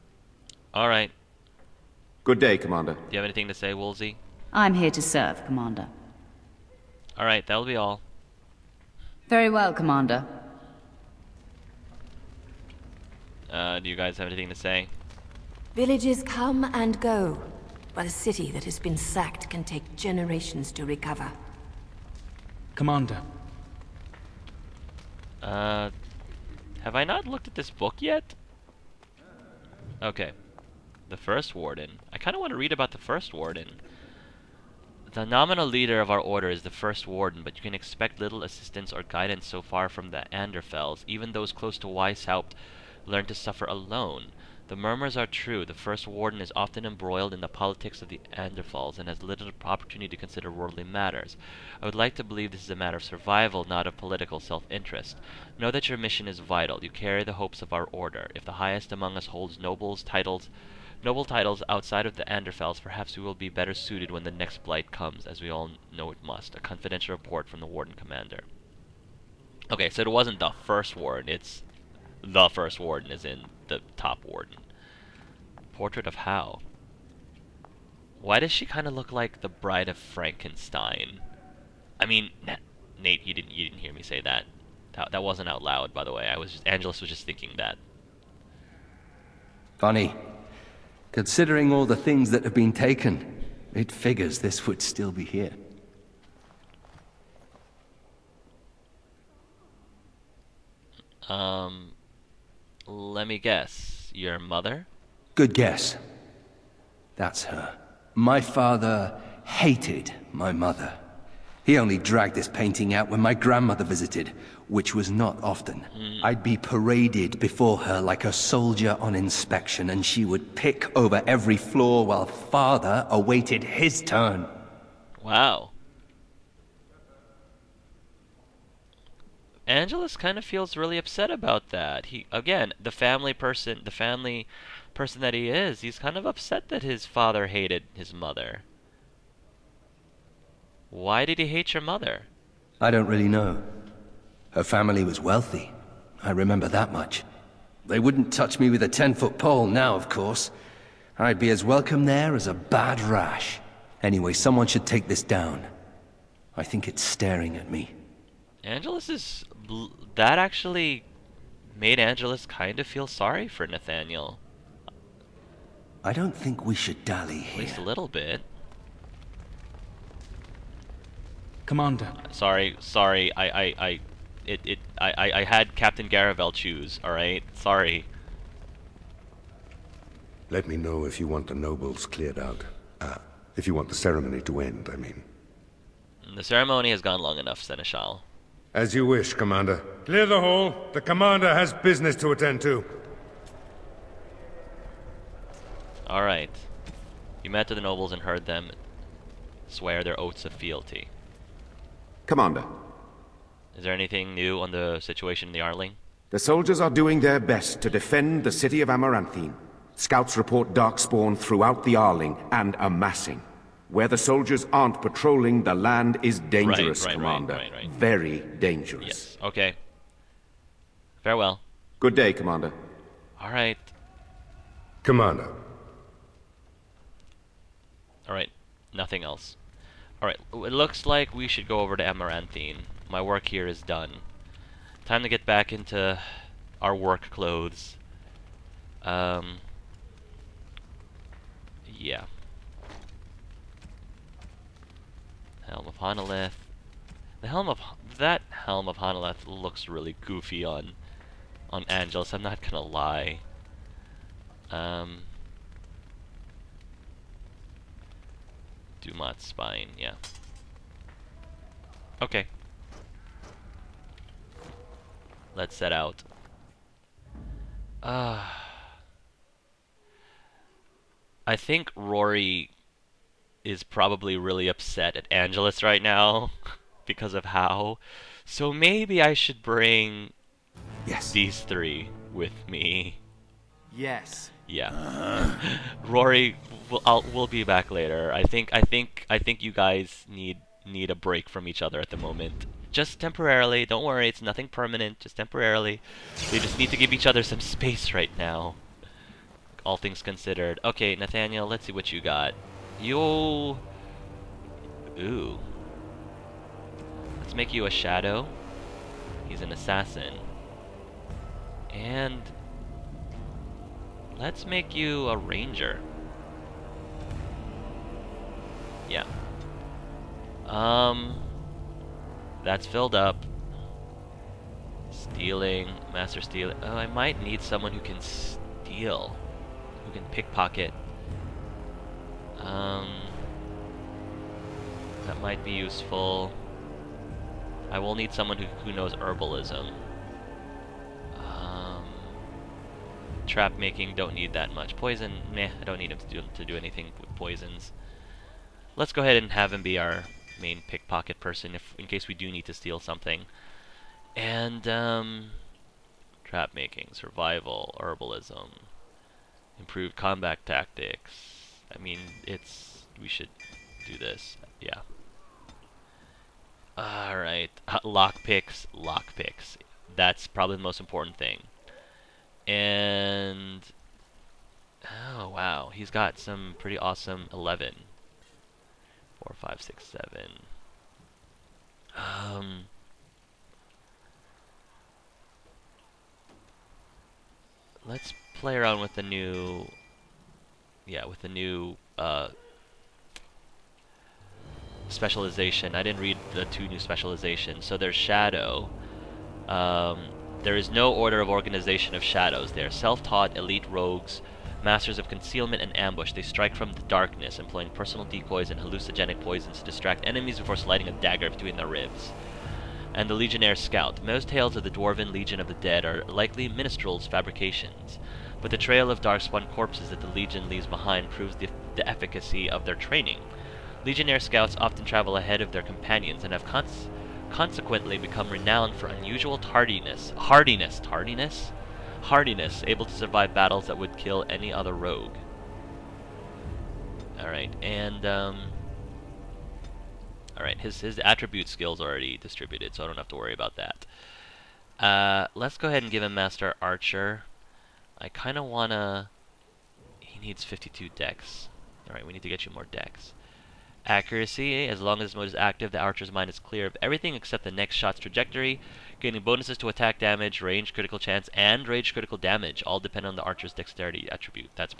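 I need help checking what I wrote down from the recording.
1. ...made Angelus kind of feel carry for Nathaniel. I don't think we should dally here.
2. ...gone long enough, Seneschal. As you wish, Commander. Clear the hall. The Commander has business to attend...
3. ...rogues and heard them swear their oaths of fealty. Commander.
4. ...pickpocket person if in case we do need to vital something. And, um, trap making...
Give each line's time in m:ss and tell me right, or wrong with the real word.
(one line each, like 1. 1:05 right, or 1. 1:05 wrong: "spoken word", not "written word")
1. 2:41 wrong: "sorry", not "carry"
2. 3:07 right
3. 3:17 wrong: "nobles", not "rogues"
4. 5:50 wrong: "steal", not "vital".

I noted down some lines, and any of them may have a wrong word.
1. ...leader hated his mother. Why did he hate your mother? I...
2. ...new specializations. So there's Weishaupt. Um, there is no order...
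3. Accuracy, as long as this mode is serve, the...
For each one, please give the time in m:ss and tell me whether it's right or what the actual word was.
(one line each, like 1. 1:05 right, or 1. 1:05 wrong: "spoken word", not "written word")
1. 2:17 wrong: "father", not "leader"
2. 6:36 wrong: "Shadow", not "Weishaupt"
3. 7:34 wrong: "active", not "serve".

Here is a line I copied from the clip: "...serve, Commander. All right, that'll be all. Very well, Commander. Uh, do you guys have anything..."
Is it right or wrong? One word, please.
right.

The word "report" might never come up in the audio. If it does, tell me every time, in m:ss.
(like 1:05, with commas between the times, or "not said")
1:07, 3:30.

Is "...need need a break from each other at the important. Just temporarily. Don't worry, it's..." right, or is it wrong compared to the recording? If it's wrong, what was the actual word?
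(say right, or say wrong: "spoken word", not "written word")
wrong: "moment", not "important".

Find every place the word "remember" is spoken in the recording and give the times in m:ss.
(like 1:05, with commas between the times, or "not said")
2:26.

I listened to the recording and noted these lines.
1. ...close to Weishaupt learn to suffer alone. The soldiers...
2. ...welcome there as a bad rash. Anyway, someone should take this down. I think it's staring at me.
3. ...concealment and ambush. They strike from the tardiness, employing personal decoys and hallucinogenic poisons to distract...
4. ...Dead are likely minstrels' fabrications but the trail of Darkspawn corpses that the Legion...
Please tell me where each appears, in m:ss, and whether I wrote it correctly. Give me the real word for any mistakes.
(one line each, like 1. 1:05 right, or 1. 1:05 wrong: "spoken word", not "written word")
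1. 0:41 wrong: "murmurs", not "soldiers"
2. 2:31 right
3. 6:45 wrong: "darkness", not "tardiness"
4. 6:55 right.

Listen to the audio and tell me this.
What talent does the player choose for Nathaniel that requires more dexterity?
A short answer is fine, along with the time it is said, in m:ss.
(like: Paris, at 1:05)
Master Archer, at 7:26.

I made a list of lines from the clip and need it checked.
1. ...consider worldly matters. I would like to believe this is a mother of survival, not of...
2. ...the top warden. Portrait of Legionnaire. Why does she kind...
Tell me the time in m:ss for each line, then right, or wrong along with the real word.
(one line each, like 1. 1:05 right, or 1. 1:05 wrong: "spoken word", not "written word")
1. 0:50 wrong: "matter", not "mother"
2. 1:13 wrong: "Howe", not "Legionnaire".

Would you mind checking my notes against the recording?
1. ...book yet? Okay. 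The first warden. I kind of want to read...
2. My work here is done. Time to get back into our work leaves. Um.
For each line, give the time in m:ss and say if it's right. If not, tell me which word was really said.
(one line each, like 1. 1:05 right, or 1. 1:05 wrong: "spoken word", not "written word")
1. 0:27 right
2. 3:53 wrong: "clothes", not "leaves".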